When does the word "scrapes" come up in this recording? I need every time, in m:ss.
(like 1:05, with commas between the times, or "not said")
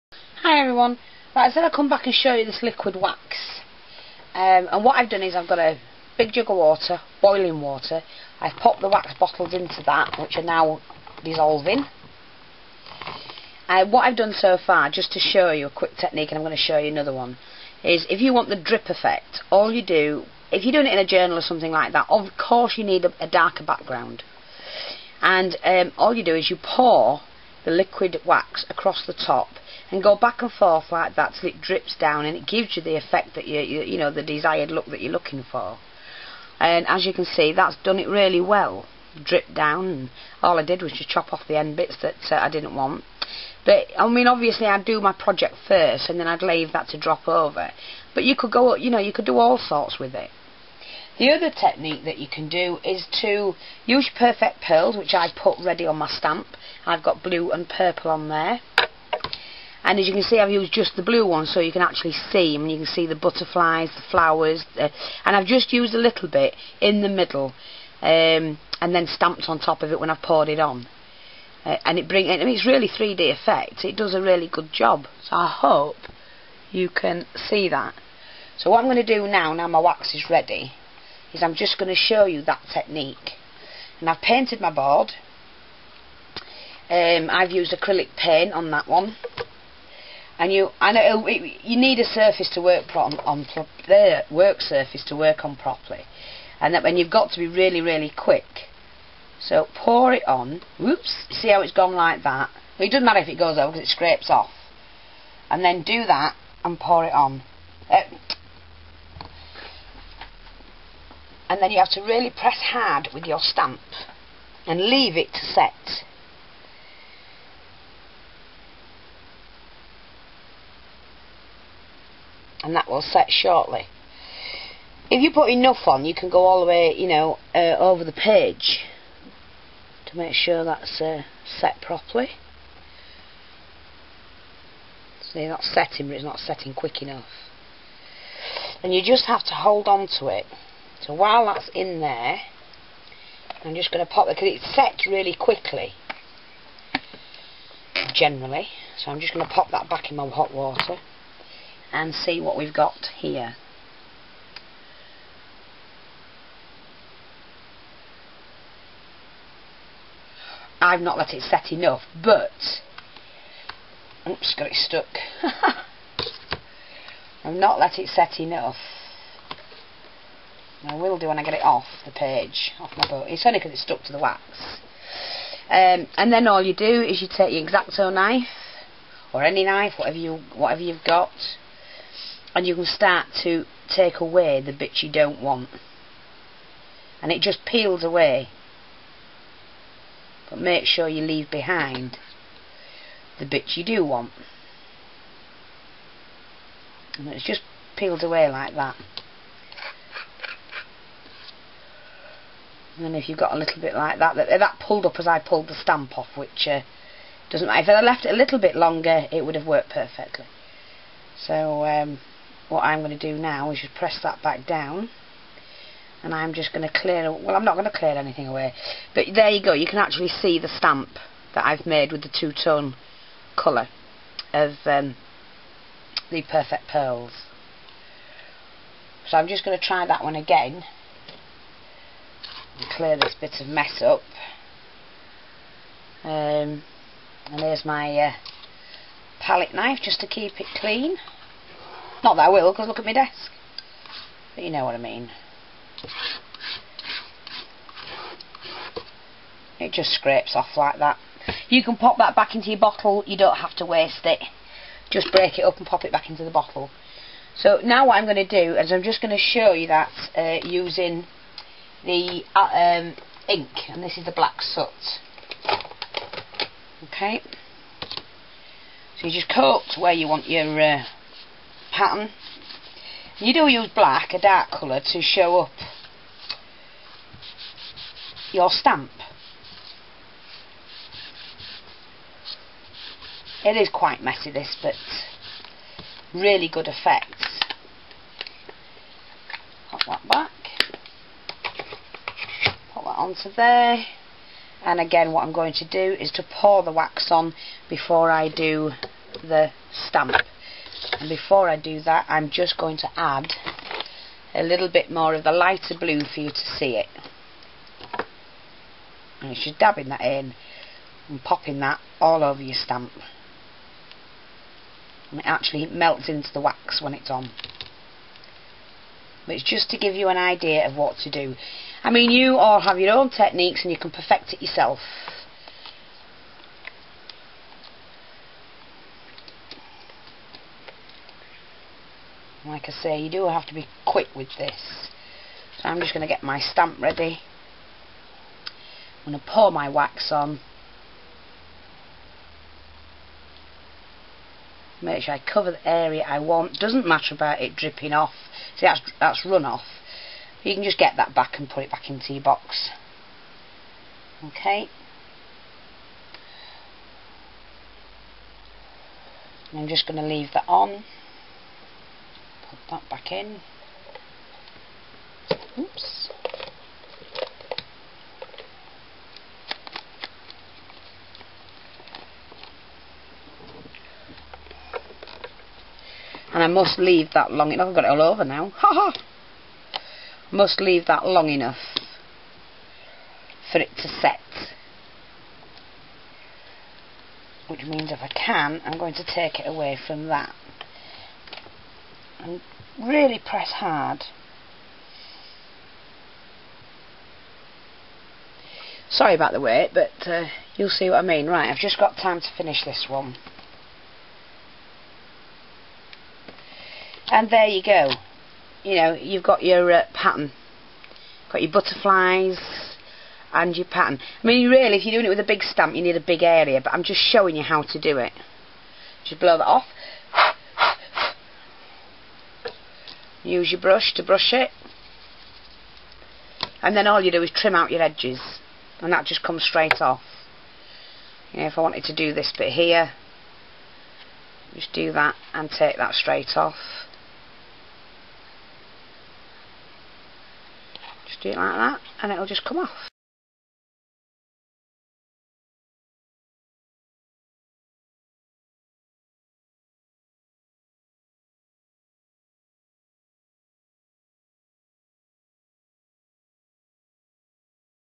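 1:43, 4:10.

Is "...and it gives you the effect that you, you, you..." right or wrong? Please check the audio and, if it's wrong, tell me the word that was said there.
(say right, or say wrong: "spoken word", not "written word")
right.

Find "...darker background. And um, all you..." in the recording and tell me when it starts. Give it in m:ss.
0:23.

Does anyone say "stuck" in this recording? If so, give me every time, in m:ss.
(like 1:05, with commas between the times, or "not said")
2:44, 2:53.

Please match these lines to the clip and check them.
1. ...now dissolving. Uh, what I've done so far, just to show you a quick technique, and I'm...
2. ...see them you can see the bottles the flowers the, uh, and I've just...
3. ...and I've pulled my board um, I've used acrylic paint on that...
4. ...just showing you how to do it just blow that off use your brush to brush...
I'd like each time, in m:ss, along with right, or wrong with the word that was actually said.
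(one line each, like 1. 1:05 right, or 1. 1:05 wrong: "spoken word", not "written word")
1. 0:10 right
2. 1:02 wrong: "butterflies", not "bottles"
3. 1:23 wrong: "painted", not "pulled"
4. 6:57 right.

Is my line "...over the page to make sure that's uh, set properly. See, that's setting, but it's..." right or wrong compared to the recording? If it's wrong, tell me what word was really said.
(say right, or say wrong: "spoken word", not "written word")
right.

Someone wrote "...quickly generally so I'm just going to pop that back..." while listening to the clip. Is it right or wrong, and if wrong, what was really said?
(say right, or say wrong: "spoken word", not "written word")
right.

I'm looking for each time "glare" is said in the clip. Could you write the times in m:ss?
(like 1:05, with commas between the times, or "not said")
not said.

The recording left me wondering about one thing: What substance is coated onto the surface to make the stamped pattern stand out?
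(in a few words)
black soot.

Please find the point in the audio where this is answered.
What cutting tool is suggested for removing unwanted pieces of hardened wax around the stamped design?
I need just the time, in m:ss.
2:57.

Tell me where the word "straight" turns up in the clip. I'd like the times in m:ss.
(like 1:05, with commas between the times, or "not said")
7:09, 7:16.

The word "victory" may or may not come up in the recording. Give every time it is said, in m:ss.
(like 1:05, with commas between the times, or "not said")
not said.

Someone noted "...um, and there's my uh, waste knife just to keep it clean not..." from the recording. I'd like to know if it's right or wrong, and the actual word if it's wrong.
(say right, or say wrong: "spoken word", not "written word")
wrong: "palette", not "waste".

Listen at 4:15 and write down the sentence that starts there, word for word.
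Just break it up and pop it back into the bottle.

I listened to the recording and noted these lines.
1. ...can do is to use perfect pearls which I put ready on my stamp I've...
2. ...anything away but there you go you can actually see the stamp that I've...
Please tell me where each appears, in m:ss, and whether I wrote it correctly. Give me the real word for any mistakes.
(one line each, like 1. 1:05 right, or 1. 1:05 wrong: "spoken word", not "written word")
1. 0:52 right
2. 3:38 right.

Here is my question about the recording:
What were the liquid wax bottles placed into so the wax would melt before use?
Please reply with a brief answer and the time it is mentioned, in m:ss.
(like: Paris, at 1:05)
boiling water, at 0:07.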